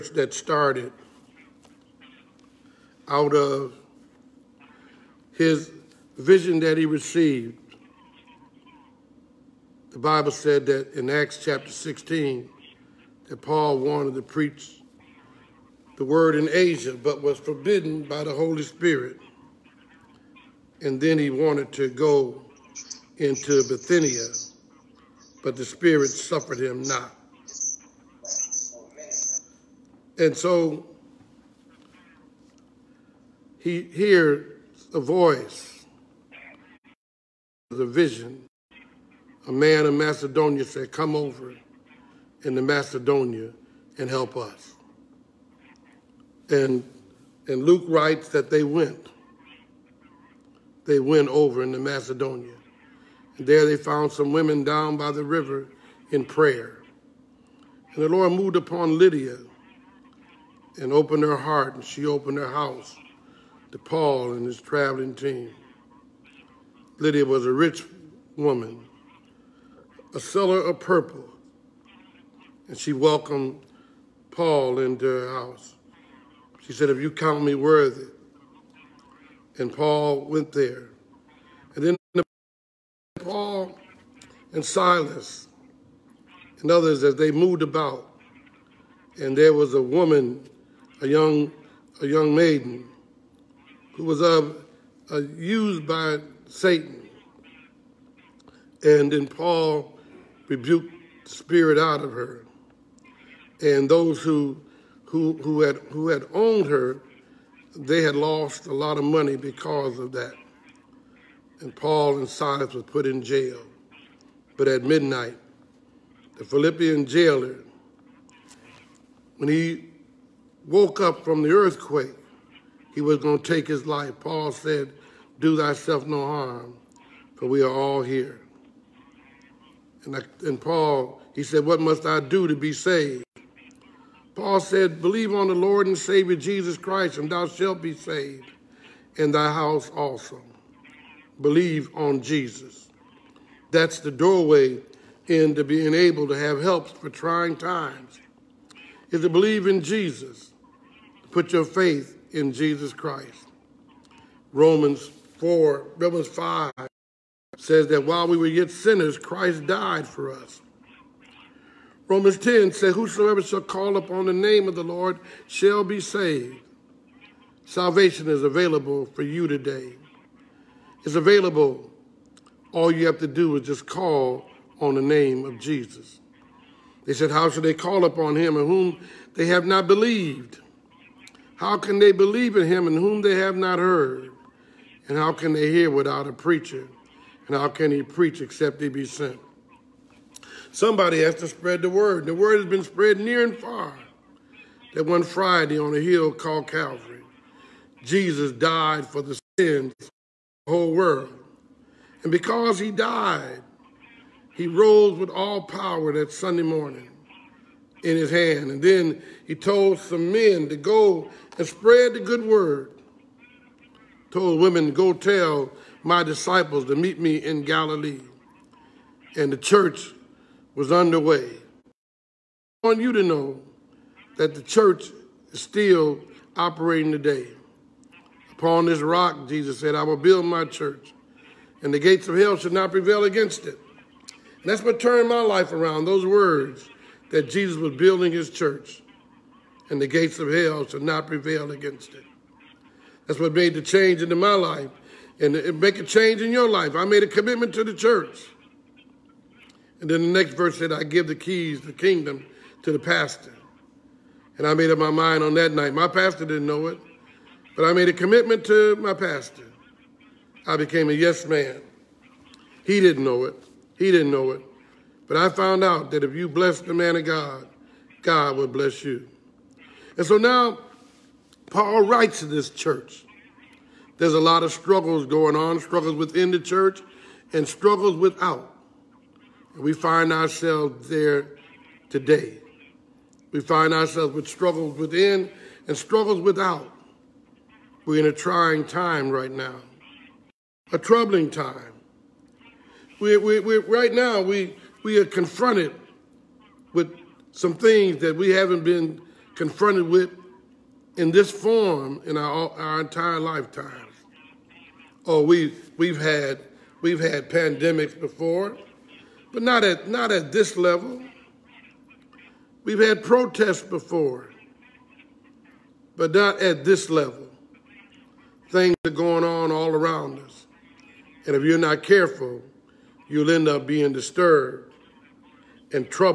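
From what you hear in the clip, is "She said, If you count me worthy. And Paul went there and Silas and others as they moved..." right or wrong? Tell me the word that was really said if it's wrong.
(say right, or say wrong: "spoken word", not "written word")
right.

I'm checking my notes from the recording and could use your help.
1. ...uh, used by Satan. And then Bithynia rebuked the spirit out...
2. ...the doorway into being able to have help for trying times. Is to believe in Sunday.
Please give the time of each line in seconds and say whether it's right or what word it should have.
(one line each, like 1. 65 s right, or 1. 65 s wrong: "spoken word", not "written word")
1. 95 s wrong: "Paul", not "Bithynia"
2. 143 s wrong: "Jesus", not "Sunday".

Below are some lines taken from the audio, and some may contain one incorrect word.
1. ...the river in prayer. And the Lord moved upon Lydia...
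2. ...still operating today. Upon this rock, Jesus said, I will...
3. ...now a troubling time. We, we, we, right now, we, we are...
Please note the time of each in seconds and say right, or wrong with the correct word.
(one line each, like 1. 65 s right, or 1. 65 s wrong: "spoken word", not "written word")
1. 55 s right
2. 225 s right
3. 289 s right.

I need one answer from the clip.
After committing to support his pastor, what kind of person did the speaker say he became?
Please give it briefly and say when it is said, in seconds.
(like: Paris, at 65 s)
A yes man, at 261 s.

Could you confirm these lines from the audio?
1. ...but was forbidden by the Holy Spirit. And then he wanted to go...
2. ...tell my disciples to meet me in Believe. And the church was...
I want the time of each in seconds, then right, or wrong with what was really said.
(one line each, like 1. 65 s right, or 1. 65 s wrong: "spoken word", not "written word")
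1. 16 s right
2. 215 s wrong: "Galilee", not "Believe".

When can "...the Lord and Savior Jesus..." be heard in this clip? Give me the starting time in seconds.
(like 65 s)
135 s.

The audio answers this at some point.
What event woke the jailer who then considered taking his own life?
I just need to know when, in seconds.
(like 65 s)
121 s.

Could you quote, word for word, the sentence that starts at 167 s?
Salvation is available for you today.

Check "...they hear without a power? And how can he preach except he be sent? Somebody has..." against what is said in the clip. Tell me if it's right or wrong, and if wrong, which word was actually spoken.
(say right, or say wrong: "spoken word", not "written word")
wrong: "preacher", not "power".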